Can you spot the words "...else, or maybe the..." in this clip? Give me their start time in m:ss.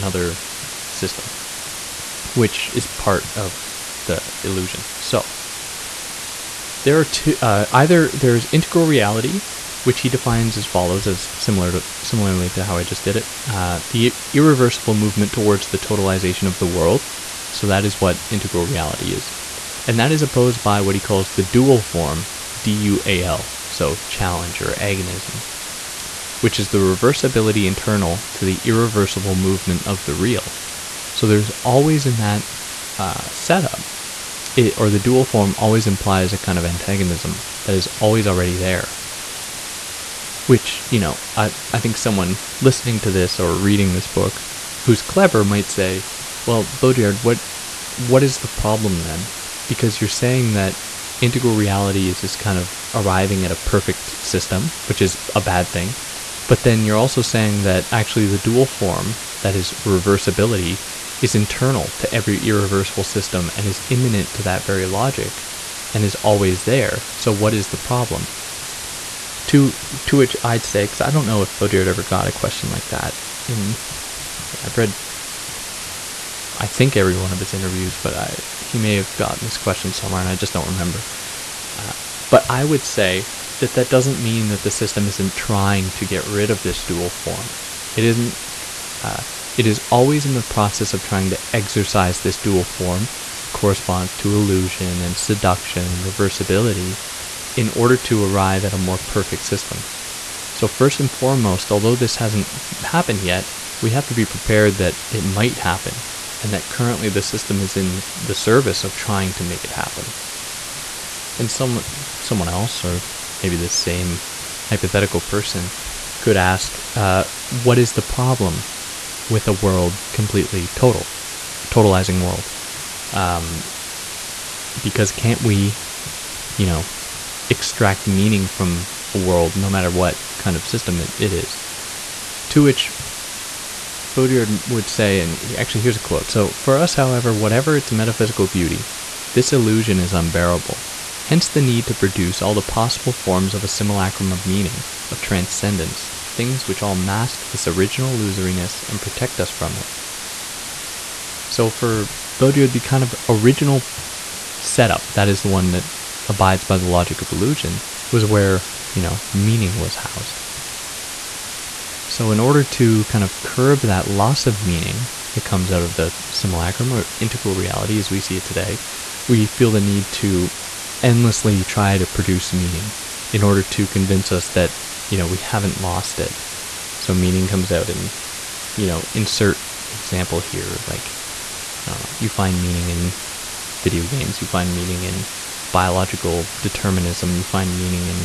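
1:52.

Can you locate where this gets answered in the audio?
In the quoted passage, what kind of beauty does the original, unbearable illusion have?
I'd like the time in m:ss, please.
2:17.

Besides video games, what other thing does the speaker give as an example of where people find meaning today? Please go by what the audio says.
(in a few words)
biological determinism.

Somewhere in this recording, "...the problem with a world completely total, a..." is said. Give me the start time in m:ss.
1:57.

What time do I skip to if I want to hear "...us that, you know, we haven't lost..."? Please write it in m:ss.
2:54.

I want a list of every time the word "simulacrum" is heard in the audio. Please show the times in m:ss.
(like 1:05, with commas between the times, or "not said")
2:23, 2:46.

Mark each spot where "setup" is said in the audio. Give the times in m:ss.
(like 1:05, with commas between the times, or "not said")
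0:33, 2:34.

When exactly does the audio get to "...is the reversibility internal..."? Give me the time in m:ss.
0:26.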